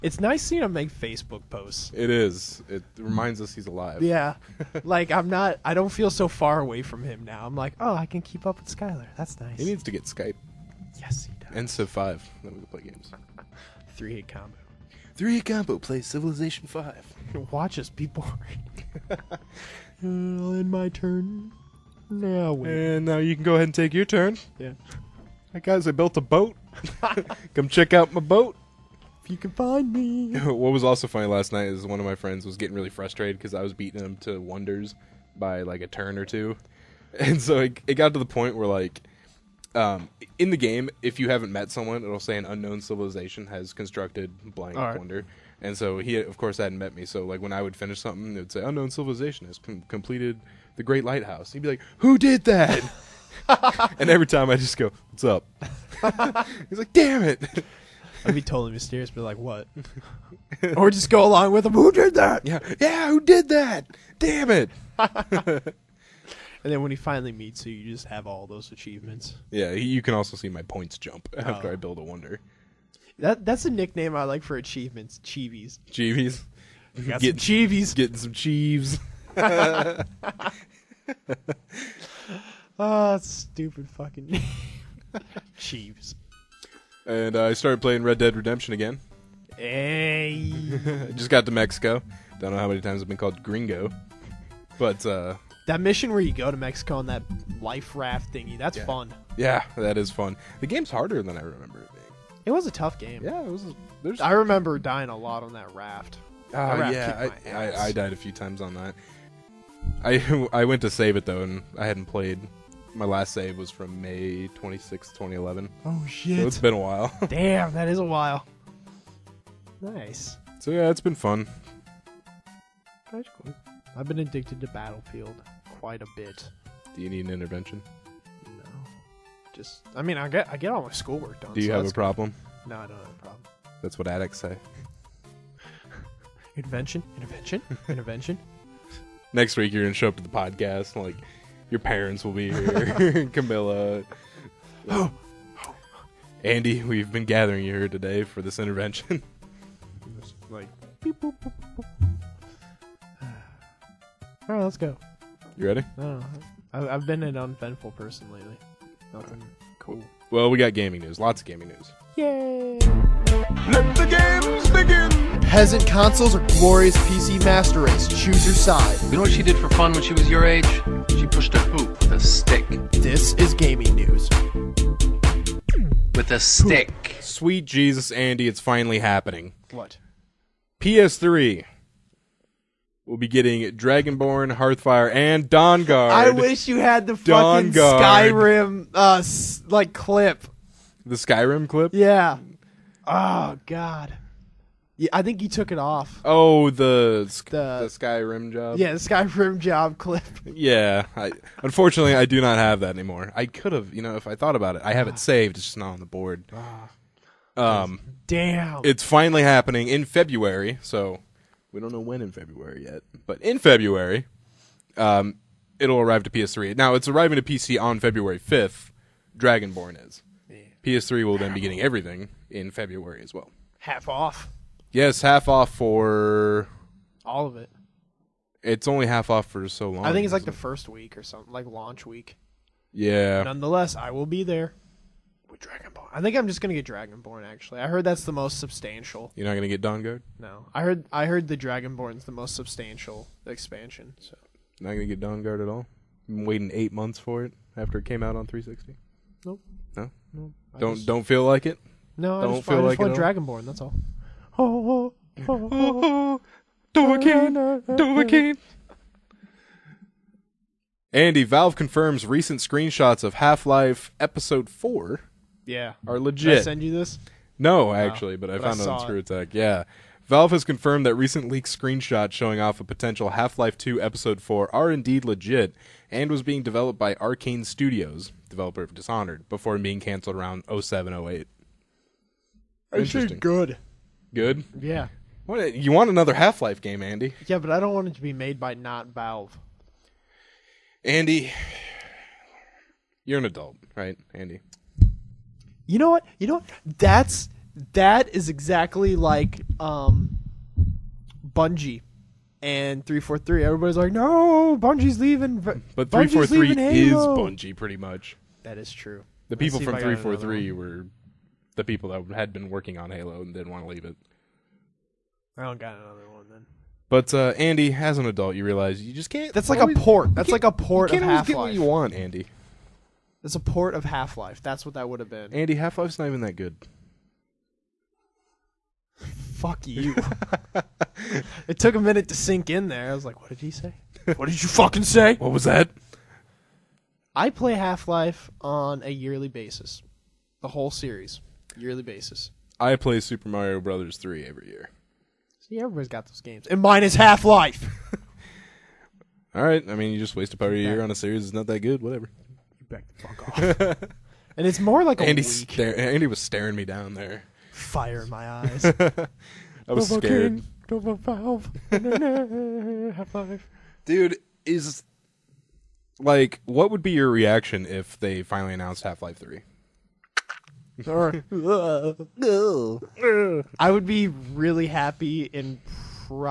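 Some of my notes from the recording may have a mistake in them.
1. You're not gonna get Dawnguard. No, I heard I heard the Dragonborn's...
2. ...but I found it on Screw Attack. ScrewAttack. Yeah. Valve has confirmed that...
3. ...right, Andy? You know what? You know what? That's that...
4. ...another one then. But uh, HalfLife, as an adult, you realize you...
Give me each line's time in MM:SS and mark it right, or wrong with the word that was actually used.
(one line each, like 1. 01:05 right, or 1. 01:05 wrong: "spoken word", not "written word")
1. 03:59 right
2. 04:28 right
3. 04:53 right
4. 05:15 wrong: "Andy", not "HalfLife".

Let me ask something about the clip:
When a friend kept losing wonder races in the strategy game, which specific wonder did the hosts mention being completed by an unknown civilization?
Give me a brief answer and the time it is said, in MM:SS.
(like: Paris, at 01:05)
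Great Lighthouse, at 00:50.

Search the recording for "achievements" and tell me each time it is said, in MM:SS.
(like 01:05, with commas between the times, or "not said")
01:08, 01:14.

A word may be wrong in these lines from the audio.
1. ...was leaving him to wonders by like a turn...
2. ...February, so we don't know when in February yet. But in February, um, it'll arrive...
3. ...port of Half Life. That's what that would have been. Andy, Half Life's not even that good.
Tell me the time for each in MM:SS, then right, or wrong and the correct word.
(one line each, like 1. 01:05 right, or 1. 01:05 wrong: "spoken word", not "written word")
1. 00:33 wrong: "beating", not "leaving"
2. 03:30 right
3. 05:23 right.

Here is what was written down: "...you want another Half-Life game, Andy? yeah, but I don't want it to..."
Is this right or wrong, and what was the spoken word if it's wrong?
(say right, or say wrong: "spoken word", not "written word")
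right.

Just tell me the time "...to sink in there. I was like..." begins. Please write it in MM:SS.
05:32.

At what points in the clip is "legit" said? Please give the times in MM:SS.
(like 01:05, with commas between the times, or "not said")
04:26, 04:35.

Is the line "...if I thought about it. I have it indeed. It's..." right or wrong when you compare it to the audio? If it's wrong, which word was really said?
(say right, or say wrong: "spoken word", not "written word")
wrong: "saved", not "indeed".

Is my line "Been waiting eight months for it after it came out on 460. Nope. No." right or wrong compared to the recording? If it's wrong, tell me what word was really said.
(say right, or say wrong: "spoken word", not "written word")
wrong: "360", not "460".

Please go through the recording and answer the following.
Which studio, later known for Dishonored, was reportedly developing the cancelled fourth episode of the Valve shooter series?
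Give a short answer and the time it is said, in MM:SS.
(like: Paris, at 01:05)
Arcane Studios, at 04:37.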